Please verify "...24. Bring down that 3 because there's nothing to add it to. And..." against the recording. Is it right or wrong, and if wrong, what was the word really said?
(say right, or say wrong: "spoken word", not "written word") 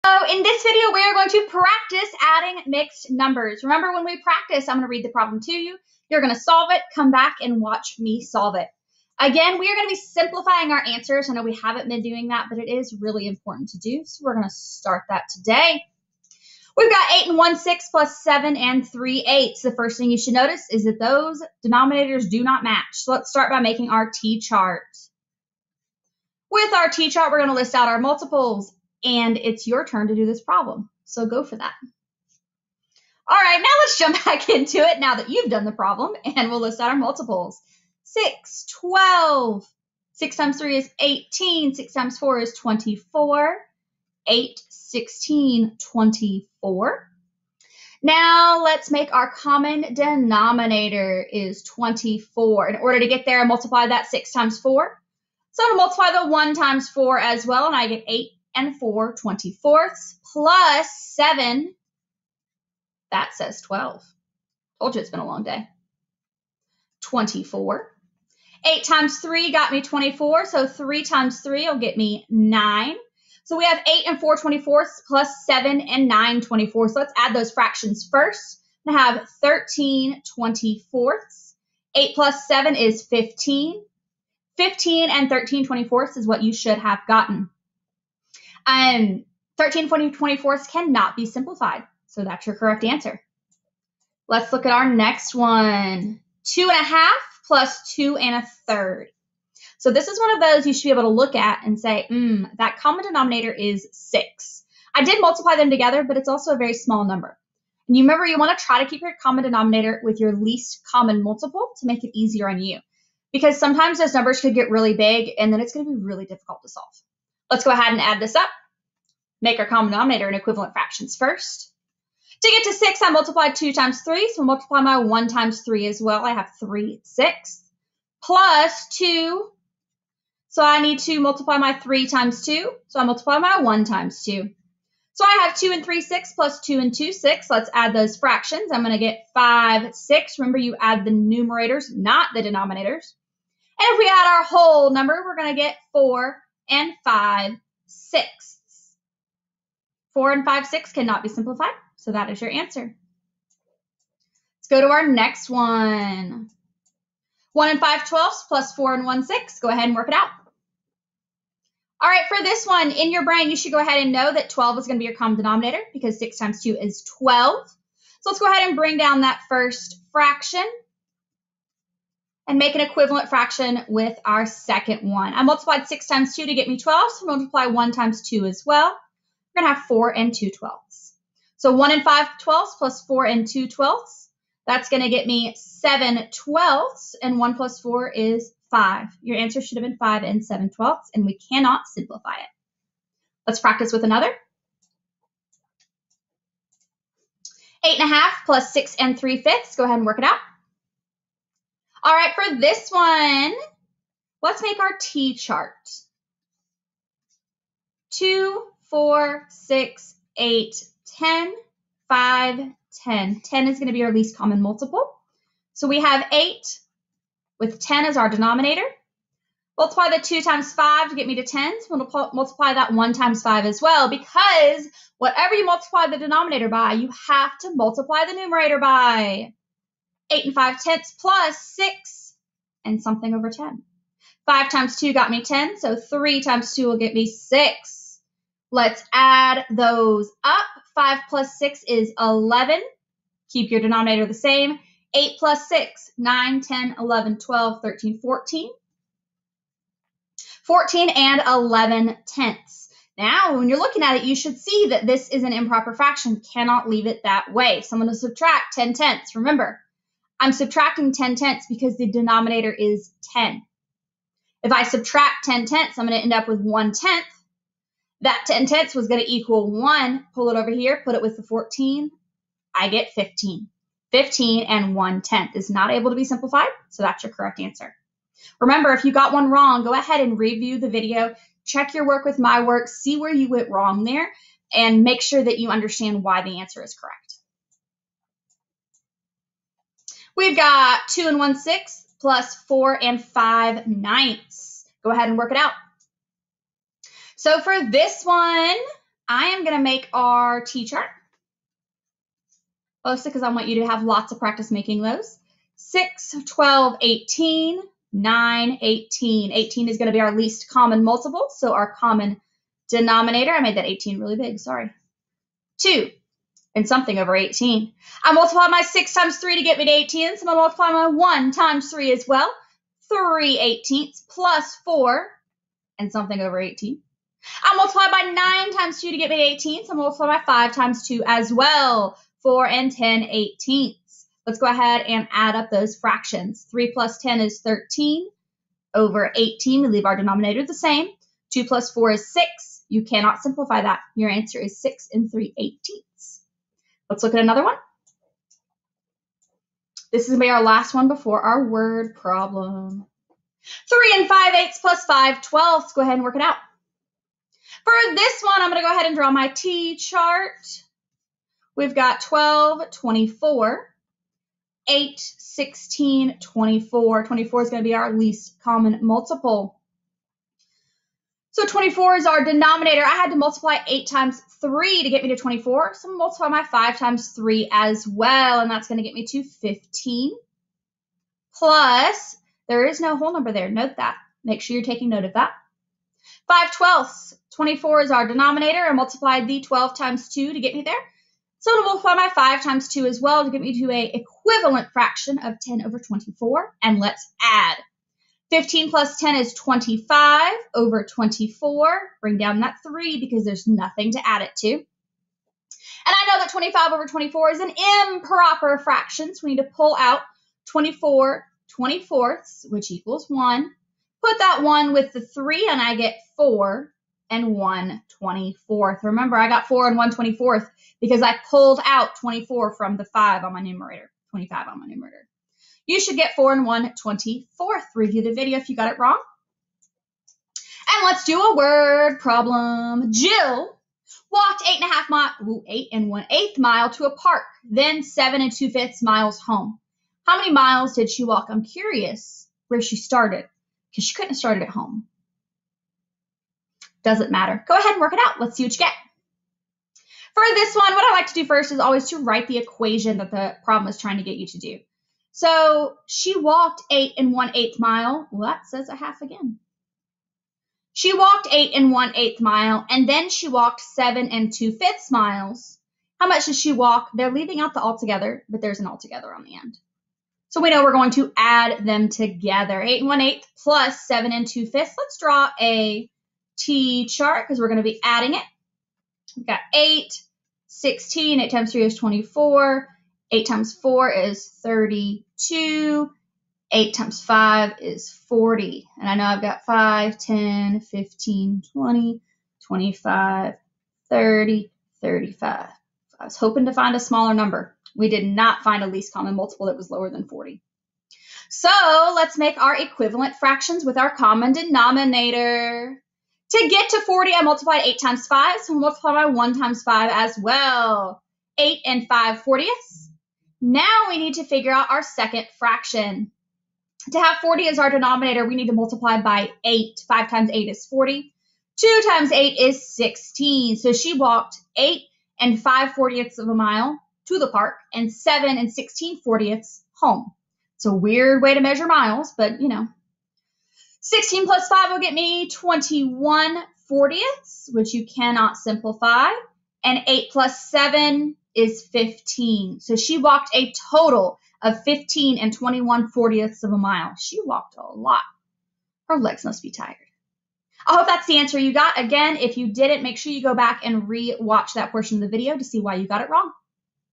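right.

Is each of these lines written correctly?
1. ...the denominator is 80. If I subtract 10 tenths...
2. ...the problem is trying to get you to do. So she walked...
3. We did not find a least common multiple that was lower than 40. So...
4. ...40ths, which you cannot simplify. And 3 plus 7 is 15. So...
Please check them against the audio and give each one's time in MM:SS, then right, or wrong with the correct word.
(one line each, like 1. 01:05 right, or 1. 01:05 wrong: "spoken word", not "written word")
1. 04:21 wrong: "10", not "80"
2. 07:33 right
3. 08:17 right
4. 08:56 wrong: "8", not "3".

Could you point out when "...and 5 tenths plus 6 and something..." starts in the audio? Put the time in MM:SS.
03:50.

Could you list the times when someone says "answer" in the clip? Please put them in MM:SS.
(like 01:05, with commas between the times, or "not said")
00:10, 01:32, 02:32, 03:09, 04:37, 04:46, 05:44, 09:11.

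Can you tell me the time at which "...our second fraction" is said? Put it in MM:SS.
08:34.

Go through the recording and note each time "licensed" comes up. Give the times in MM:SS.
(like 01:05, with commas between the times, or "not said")
not said.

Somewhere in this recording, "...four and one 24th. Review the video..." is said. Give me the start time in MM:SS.
07:06.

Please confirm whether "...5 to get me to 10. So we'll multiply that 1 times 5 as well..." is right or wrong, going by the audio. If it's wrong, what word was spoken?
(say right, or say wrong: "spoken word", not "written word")
right.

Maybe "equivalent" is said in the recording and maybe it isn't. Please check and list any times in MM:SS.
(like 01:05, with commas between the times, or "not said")
02:00, 02:52, 06:34, 08:22.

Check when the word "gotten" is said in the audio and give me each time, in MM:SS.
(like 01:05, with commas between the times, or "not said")
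01:27.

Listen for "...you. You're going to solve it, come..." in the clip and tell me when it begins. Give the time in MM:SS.
00:05.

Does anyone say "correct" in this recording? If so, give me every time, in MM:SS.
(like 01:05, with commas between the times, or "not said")
01:32, 04:37, 04:46.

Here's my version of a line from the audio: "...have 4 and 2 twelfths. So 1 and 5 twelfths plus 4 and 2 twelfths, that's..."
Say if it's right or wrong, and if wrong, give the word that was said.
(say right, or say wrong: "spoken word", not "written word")
right.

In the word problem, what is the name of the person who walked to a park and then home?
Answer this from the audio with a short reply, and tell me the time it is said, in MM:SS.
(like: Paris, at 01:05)
Jill, at 07:13.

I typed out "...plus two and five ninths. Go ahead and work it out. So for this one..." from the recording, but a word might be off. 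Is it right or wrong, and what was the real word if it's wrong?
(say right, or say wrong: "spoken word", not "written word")
wrong: "four", not "two".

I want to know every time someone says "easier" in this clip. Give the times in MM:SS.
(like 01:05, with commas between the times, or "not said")
01:52.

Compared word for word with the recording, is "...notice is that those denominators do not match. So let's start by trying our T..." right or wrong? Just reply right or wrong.
wrong.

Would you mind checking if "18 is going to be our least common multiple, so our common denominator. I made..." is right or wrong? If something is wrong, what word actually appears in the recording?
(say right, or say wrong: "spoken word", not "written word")
right.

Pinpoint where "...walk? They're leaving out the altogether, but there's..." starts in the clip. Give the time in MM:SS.
07:46.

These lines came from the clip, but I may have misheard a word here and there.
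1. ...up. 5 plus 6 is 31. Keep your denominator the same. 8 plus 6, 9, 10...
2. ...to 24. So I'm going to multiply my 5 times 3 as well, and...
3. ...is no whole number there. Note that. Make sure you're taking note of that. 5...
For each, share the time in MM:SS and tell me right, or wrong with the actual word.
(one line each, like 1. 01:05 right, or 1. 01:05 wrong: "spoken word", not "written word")
1. 04:00 wrong: "11", not "31"
2. 06:15 right
3. 06:22 right.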